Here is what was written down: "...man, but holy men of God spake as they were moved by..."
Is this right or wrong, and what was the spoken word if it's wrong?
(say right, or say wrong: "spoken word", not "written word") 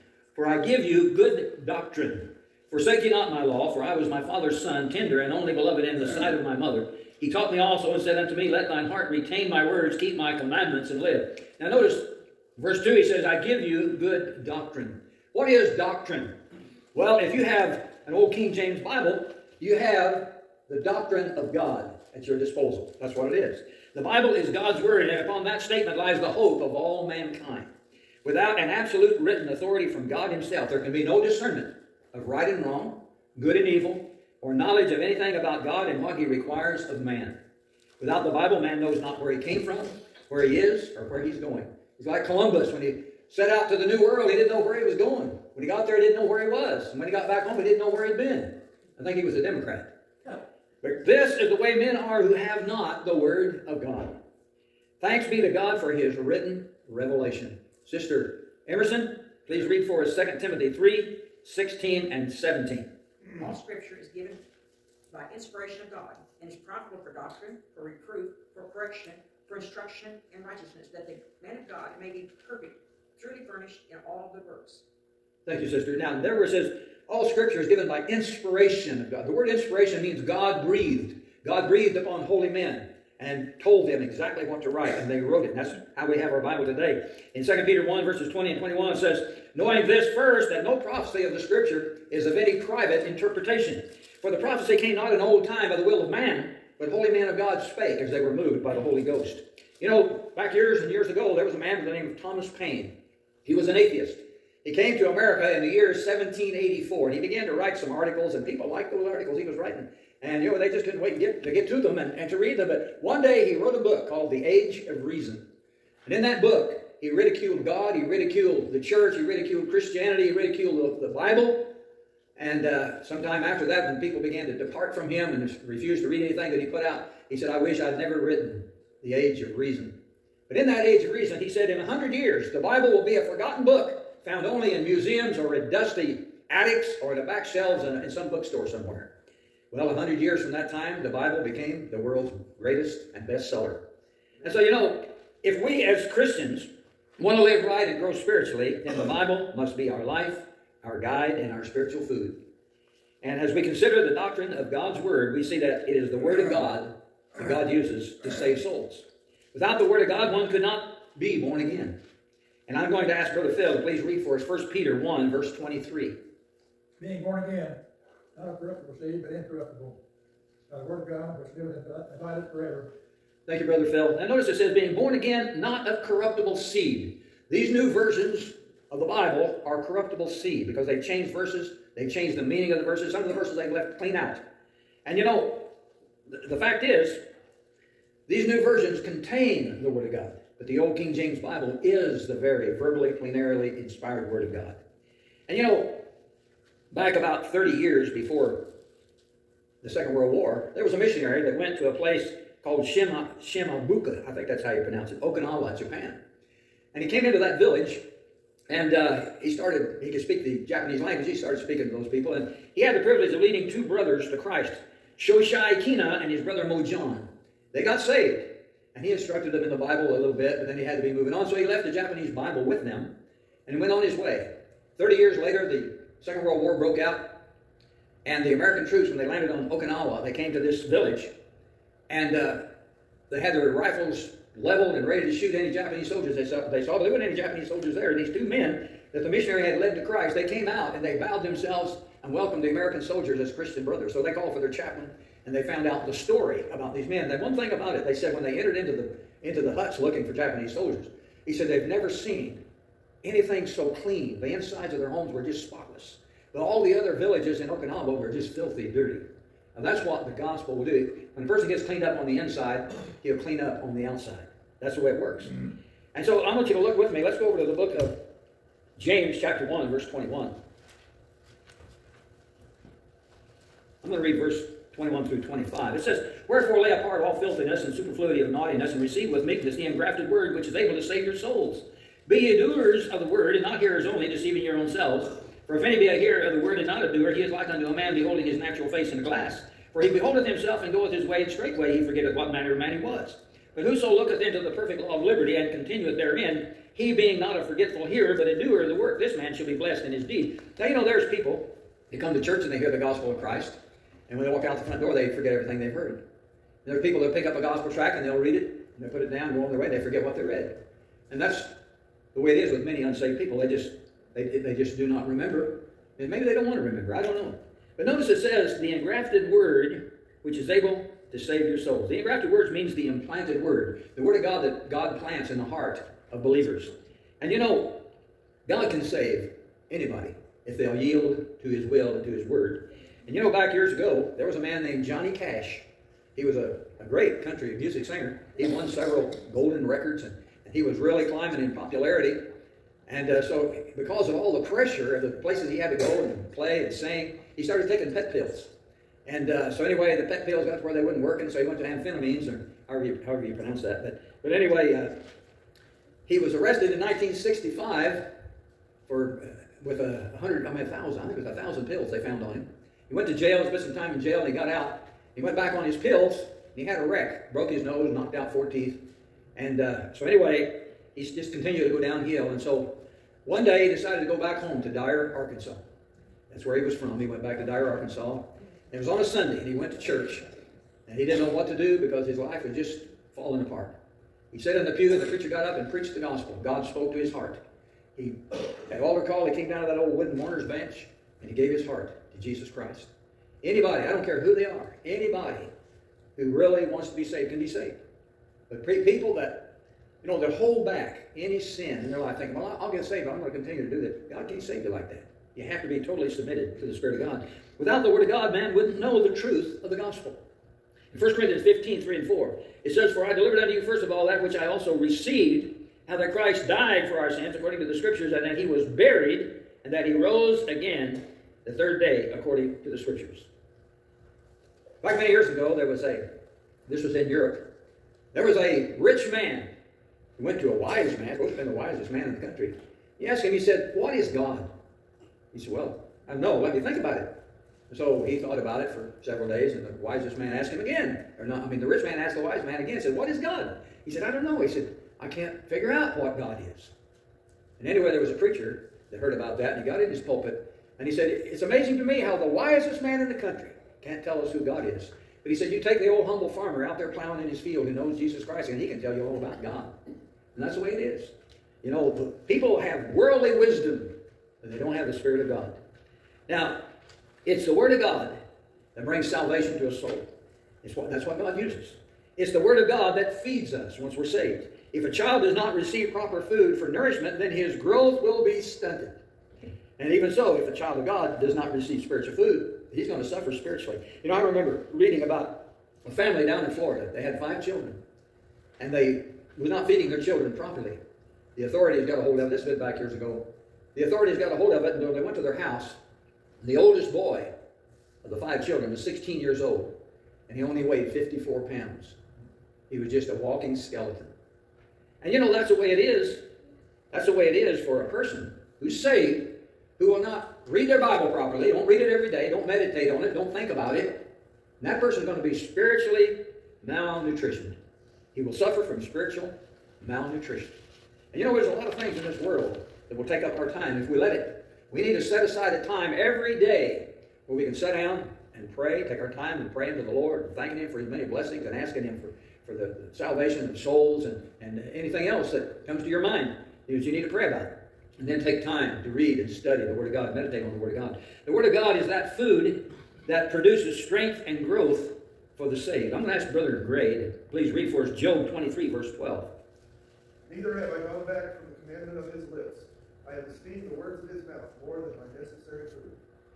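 right.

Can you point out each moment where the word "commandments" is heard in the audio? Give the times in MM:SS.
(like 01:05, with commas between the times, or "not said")
00:10, 09:11.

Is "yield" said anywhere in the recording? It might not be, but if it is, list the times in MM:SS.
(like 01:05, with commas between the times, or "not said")
05:30.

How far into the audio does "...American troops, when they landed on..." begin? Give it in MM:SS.
03:48.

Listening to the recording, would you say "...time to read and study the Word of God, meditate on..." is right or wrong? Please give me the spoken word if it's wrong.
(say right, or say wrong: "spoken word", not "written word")
right.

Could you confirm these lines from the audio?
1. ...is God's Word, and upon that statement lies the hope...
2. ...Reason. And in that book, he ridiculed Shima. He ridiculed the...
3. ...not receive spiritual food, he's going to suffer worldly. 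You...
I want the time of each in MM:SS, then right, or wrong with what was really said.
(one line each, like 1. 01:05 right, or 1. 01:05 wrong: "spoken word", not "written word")
1. 00:24 right
2. 01:55 wrong: "God", not "Shima"
3. 08:01 wrong: "spiritually", not "worldly".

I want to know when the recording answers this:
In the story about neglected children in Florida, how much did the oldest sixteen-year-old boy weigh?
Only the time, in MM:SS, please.
08:21.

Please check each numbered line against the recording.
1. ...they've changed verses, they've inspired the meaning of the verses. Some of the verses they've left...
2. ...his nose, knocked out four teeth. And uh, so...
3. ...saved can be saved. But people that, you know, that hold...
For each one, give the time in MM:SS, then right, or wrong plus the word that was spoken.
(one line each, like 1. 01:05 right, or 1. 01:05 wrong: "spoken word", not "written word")
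1. 03:00 wrong: "changed", not "inspired"
2. 06:07 right
3. 06:37 right.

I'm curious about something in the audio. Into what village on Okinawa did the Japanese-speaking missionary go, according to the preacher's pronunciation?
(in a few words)
Shimabuka.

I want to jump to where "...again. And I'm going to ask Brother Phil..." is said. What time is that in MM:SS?
02:41.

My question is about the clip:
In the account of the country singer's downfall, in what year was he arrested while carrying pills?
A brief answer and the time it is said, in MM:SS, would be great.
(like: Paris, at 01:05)
1965, at 05:56.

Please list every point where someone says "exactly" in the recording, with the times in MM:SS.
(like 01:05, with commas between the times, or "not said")
01:24.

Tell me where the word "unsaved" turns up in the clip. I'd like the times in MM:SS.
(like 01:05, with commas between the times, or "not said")
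05:13.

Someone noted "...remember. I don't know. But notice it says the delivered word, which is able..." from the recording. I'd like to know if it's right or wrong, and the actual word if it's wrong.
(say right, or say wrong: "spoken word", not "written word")
wrong: "engrafted", not "delivered".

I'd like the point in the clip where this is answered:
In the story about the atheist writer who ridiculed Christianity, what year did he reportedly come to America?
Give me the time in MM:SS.
01:45.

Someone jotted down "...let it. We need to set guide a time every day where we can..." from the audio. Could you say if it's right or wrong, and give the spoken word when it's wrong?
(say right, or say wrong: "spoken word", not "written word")
wrong: "aside", not "guide".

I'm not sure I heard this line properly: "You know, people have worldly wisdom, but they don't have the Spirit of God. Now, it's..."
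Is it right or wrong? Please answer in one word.
right.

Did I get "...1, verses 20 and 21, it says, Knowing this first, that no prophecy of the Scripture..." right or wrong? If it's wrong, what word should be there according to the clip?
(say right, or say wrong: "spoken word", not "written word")
right.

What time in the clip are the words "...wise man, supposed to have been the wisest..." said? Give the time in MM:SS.
07:10.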